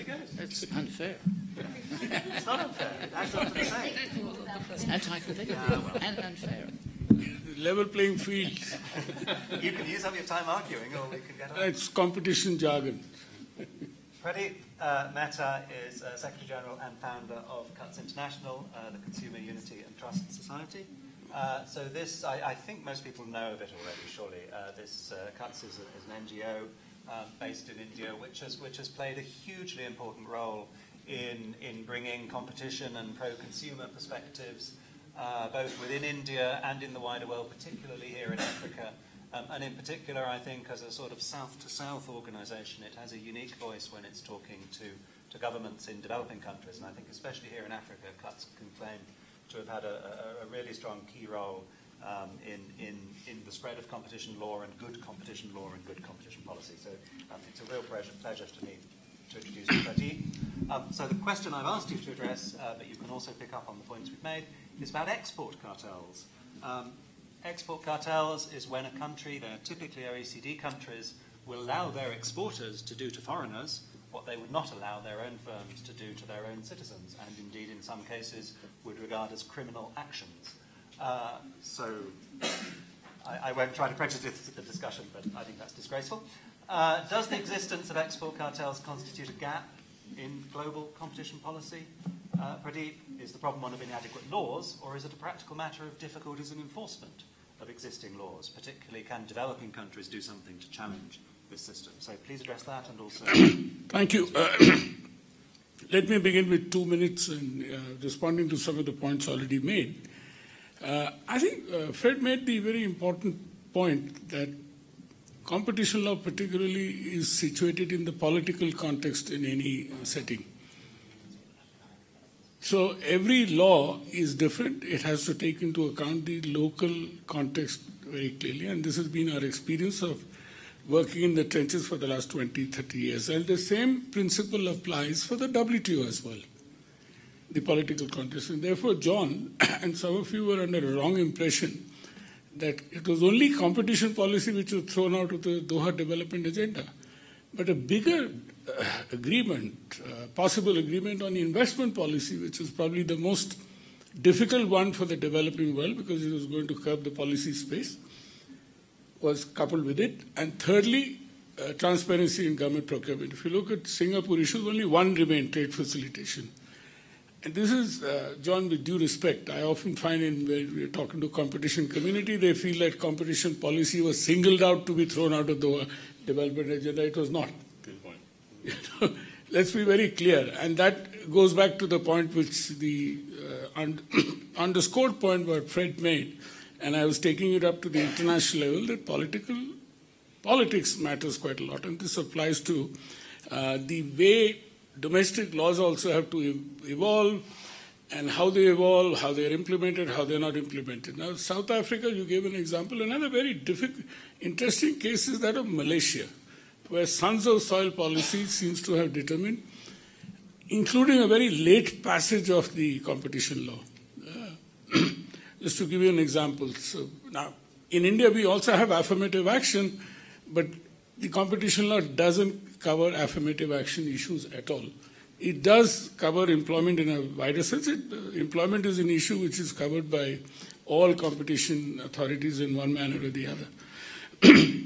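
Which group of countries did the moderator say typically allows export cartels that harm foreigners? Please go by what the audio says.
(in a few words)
OECD countries.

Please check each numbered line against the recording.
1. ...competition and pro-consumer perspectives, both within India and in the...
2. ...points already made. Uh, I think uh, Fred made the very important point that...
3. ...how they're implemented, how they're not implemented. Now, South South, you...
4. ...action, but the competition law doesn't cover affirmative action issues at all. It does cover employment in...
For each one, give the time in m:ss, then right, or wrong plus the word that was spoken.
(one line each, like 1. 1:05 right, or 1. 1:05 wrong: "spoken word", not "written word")
1. 0:32 right
2. 1:48 right
3. 3:19 wrong: "Africa", not "South"
4. 3:39 right.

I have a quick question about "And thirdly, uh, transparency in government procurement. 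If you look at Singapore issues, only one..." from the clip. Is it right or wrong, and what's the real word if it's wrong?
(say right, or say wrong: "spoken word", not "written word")
right.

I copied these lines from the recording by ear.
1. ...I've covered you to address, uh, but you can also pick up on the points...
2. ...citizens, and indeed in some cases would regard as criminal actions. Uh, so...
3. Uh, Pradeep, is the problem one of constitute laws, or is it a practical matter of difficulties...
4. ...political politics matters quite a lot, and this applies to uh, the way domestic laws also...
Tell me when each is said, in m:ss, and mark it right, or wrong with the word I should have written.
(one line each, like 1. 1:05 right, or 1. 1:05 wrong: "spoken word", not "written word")
1. 1:01 wrong: "asked", not "covered"
2. 1:16 right
3. 1:32 wrong: "inadequate", not "constitute"
4. 3:09 right.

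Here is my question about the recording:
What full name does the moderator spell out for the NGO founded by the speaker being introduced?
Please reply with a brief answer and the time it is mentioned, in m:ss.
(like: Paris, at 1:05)
Consumer Unity and Trust Society, at 0:18.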